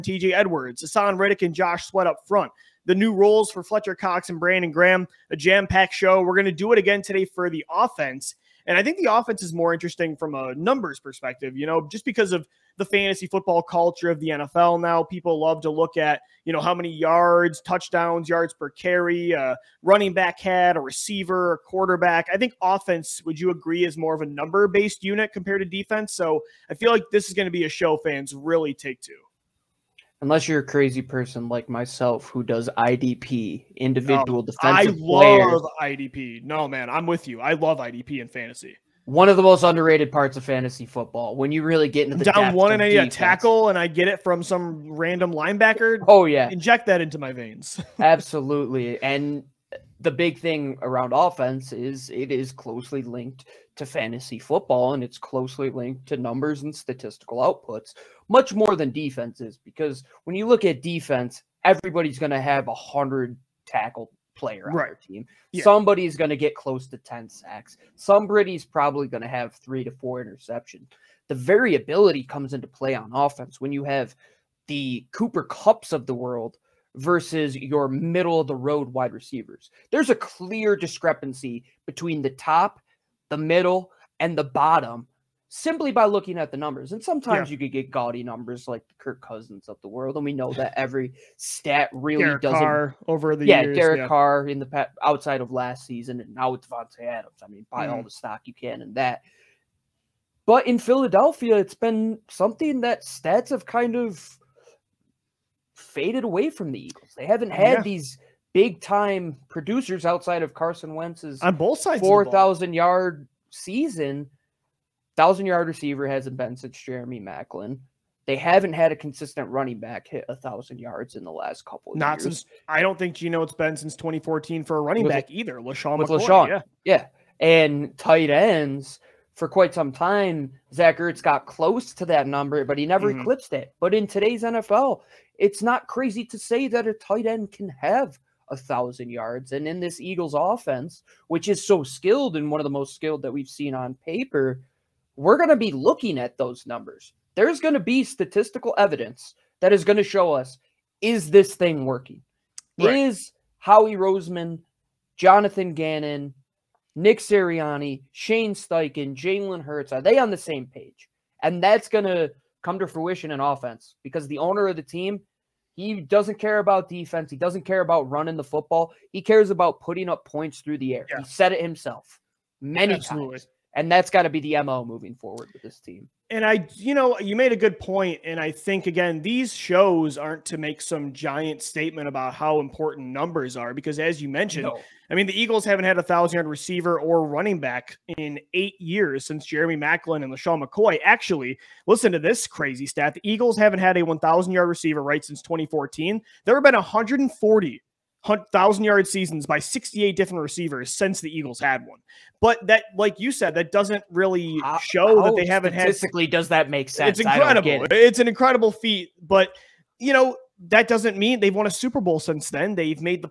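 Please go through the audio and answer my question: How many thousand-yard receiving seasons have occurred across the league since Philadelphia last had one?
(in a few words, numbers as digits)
140.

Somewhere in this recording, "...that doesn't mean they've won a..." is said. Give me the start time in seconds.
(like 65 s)
210 s.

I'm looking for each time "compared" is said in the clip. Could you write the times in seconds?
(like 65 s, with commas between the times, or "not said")
25 s.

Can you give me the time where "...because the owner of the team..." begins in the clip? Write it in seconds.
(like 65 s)
164 s.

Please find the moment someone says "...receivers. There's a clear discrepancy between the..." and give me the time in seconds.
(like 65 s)
79 s.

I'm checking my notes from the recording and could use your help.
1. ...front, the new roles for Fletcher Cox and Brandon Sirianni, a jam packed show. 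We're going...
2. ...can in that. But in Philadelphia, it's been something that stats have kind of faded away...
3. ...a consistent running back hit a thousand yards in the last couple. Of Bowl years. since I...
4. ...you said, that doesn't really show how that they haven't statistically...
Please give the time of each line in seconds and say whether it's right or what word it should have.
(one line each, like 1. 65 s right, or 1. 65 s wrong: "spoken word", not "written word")
1. 2 s wrong: "Graham", not "Sirianni"
2. 98 s right
3. 118 s wrong: "Not", not "Bowl"
4. 203 s right.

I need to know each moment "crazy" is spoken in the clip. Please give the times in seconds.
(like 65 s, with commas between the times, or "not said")
30 s, 135 s, 192 s.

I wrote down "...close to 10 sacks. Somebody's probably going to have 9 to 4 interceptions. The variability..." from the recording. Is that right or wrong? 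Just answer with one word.
wrong.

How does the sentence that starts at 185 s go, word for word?
I mean, the Eagles haven't had a thousand yard receiver or running back in eight years since Jeremy Maclin and LeSean McCoy.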